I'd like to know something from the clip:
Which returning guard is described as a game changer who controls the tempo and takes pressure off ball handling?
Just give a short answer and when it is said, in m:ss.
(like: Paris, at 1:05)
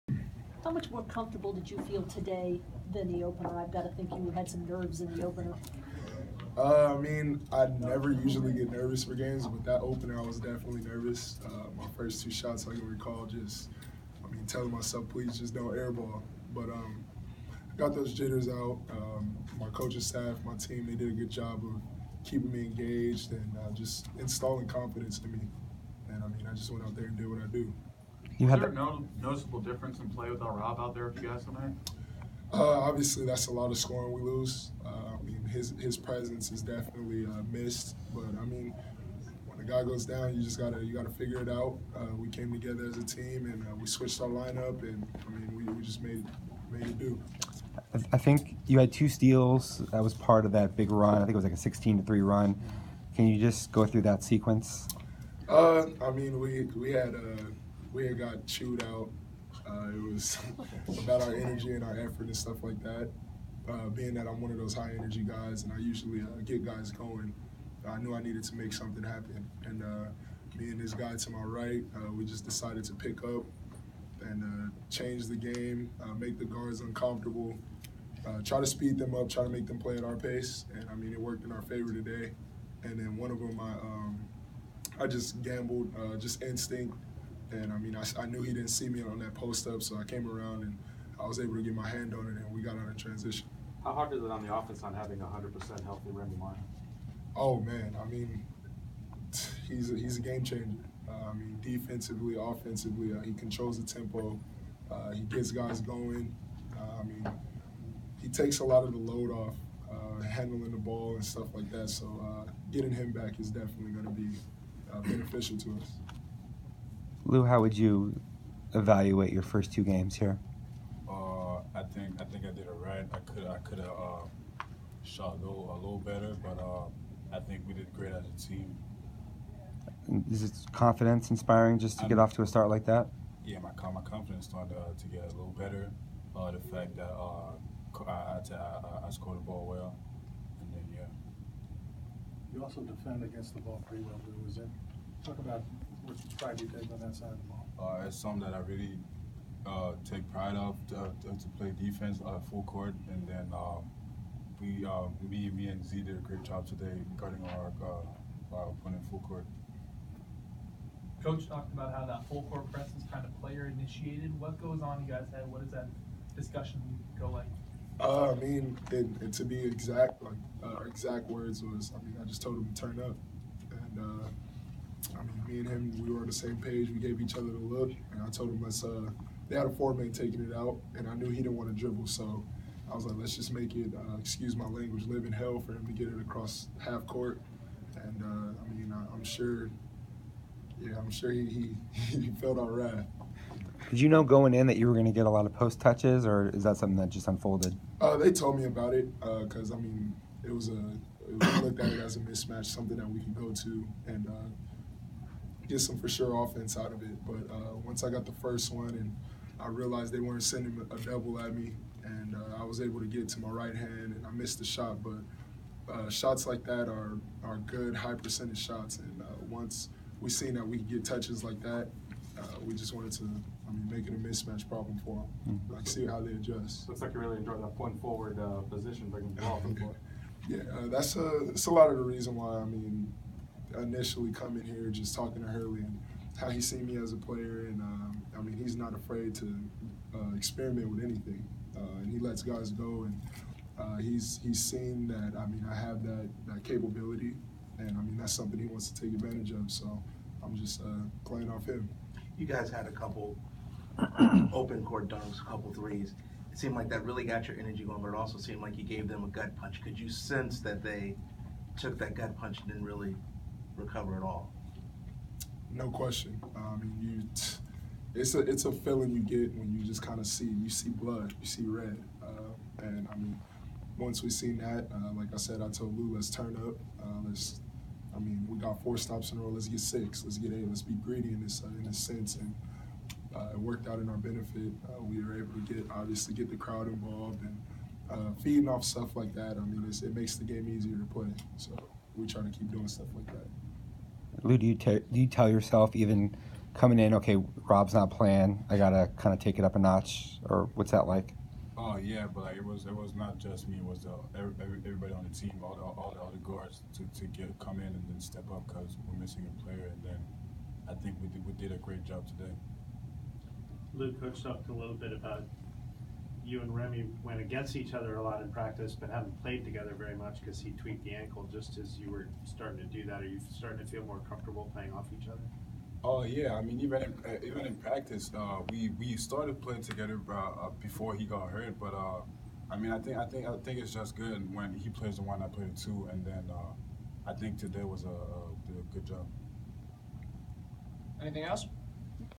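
Remy Martin, at 1:36.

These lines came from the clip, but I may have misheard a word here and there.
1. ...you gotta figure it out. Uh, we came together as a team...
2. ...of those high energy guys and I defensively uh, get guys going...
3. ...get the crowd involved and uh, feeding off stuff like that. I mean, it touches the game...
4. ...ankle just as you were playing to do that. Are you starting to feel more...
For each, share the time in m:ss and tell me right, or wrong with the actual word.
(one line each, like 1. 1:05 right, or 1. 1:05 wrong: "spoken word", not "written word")
1. 0:40 right
2. 1:04 wrong: "usually", not "defensively"
3. 4:46 wrong: "makes", not "touches"
4. 5:21 wrong: "starting", not "playing".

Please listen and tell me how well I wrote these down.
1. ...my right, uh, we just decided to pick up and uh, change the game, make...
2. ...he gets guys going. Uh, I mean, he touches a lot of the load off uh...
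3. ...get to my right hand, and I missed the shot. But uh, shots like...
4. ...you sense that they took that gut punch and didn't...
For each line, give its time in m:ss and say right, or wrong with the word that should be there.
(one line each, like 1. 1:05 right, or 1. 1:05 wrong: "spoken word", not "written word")
1. 1:11 right
2. 1:45 wrong: "takes", not "touches"
3. 3:33 right
4. 4:19 right.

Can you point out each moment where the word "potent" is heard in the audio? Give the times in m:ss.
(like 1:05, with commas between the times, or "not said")
not said.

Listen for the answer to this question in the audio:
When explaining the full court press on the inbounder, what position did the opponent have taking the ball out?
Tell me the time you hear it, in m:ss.
2:59.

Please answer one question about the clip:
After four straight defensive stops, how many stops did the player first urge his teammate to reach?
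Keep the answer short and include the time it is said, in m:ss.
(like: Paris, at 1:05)
6, at 4:39.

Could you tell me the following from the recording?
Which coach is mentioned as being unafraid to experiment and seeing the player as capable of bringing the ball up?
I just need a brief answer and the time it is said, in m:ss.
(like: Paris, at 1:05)
Hurley, at 3:55.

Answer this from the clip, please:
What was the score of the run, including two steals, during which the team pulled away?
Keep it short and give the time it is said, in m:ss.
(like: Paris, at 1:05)
16 to 3, at 0:51.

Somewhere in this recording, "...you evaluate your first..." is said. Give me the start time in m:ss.
1:57.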